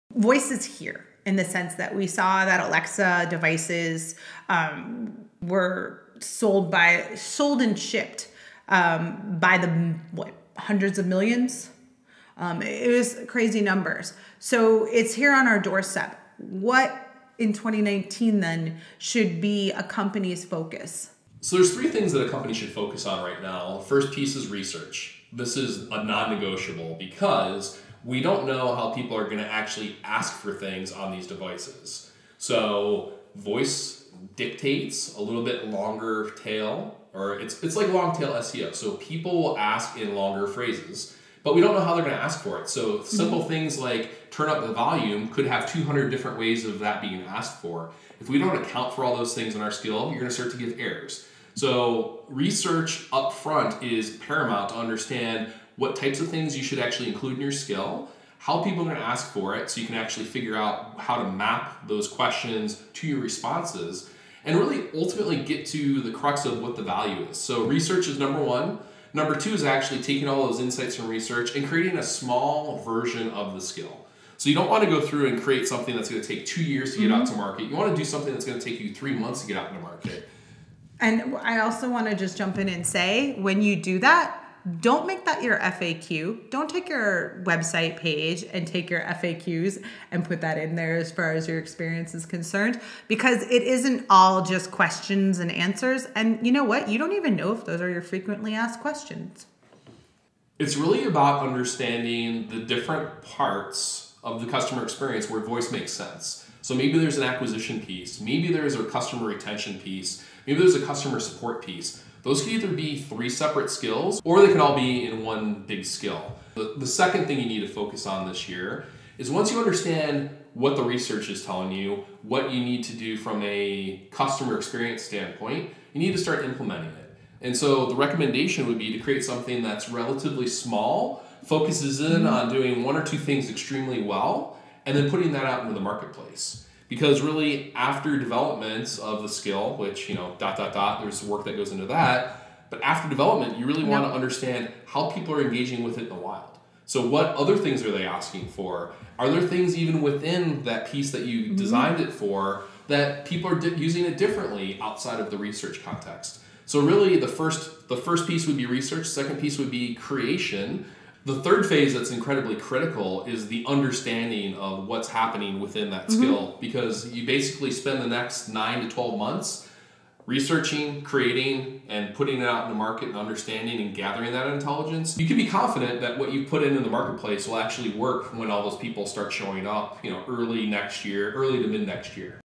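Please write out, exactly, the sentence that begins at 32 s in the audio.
So voice dictates a little bit longer tail, or it's it's like long tail SEO.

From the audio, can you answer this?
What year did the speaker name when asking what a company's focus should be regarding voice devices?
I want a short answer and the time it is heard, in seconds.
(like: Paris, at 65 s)
2019, at 17 s.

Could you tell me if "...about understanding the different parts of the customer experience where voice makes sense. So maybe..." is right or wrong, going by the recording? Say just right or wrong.
right.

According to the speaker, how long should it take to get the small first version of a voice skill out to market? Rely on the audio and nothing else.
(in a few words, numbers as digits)
3 months.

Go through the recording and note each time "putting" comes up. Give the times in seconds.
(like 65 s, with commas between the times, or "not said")
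135 s, 172 s.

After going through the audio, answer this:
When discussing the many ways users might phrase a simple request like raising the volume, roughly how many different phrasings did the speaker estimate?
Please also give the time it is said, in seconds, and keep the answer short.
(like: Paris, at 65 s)
200, at 45 s.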